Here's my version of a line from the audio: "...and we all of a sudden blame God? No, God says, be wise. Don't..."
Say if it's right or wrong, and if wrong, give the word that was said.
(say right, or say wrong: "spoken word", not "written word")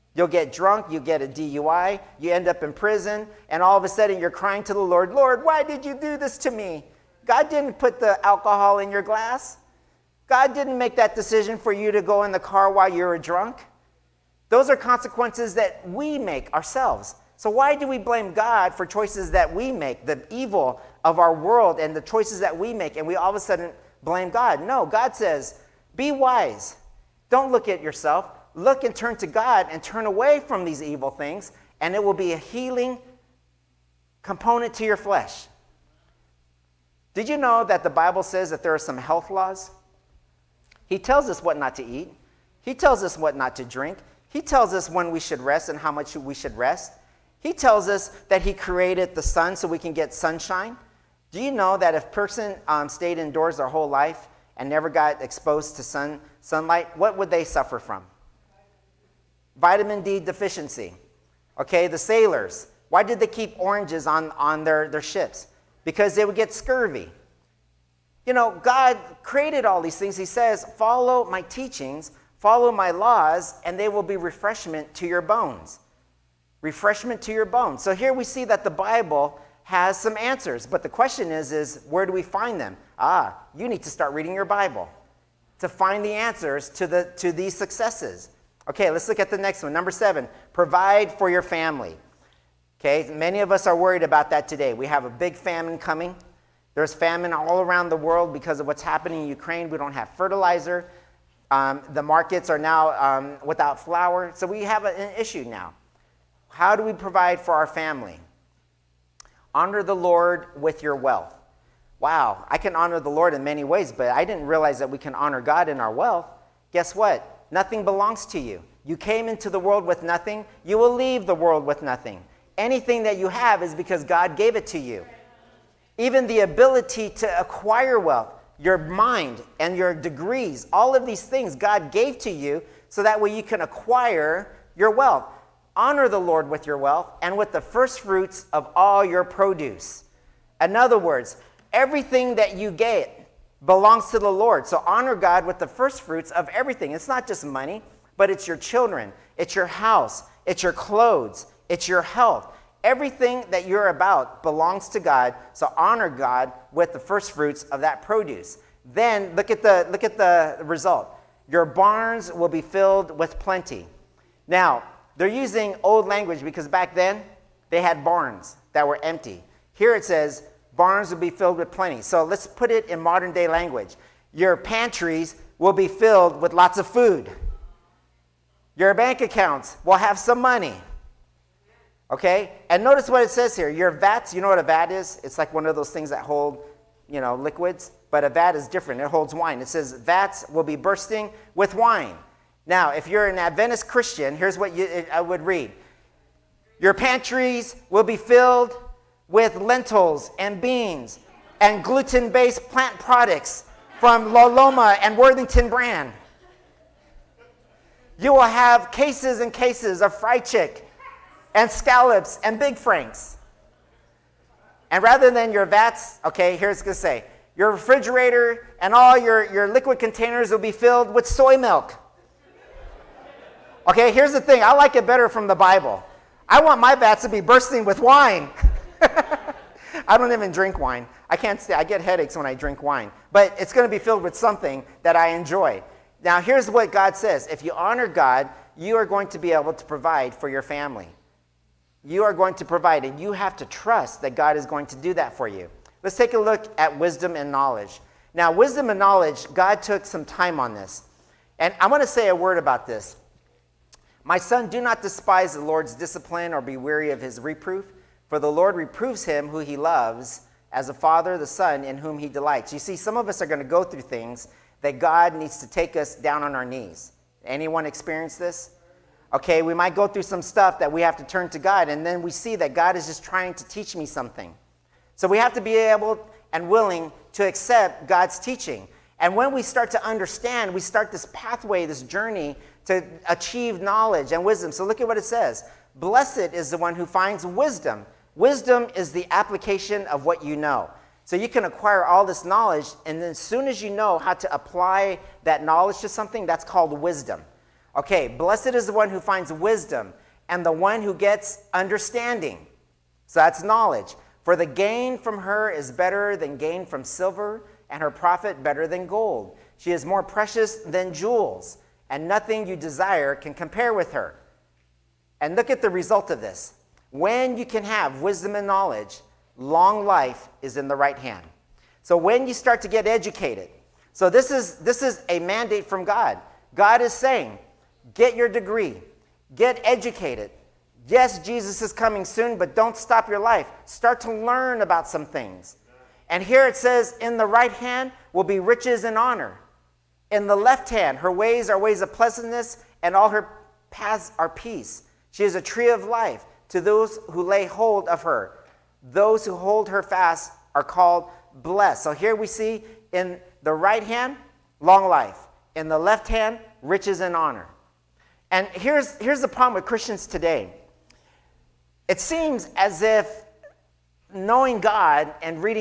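right.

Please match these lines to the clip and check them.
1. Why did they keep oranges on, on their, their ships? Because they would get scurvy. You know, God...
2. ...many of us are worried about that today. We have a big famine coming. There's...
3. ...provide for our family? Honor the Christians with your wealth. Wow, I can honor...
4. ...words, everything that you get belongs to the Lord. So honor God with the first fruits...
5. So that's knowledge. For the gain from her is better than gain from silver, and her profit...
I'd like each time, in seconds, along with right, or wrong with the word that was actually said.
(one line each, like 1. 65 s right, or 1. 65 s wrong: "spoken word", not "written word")
1. 62 s right
2. 93 s right
3. 106 s wrong: "Lord", not "Christians"
4. 140 s right
5. 303 s right.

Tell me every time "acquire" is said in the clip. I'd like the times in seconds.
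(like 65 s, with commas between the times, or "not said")
127 s, 133 s, 291 s.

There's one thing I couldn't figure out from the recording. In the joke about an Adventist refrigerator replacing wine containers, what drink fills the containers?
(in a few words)
soy milk.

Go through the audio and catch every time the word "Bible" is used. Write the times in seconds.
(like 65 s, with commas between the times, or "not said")
37 s, 78 s, 84 s, 225 s.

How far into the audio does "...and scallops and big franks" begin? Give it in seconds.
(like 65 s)
211 s.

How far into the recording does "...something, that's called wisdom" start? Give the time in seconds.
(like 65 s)
296 s.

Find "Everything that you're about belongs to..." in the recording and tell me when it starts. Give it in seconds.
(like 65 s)
152 s.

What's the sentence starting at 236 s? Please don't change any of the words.
Now, here's what God says if you honor God, you are going to be able to provide for your family.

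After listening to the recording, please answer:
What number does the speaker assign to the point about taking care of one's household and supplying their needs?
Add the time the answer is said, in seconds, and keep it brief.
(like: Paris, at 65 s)
7, at 89 s.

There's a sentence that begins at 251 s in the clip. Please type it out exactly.
And I want to say a word about this.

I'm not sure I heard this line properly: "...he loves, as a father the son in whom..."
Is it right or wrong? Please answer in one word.
right.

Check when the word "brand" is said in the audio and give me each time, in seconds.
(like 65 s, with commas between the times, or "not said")
205 s.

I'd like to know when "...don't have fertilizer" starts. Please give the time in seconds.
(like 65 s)
99 s.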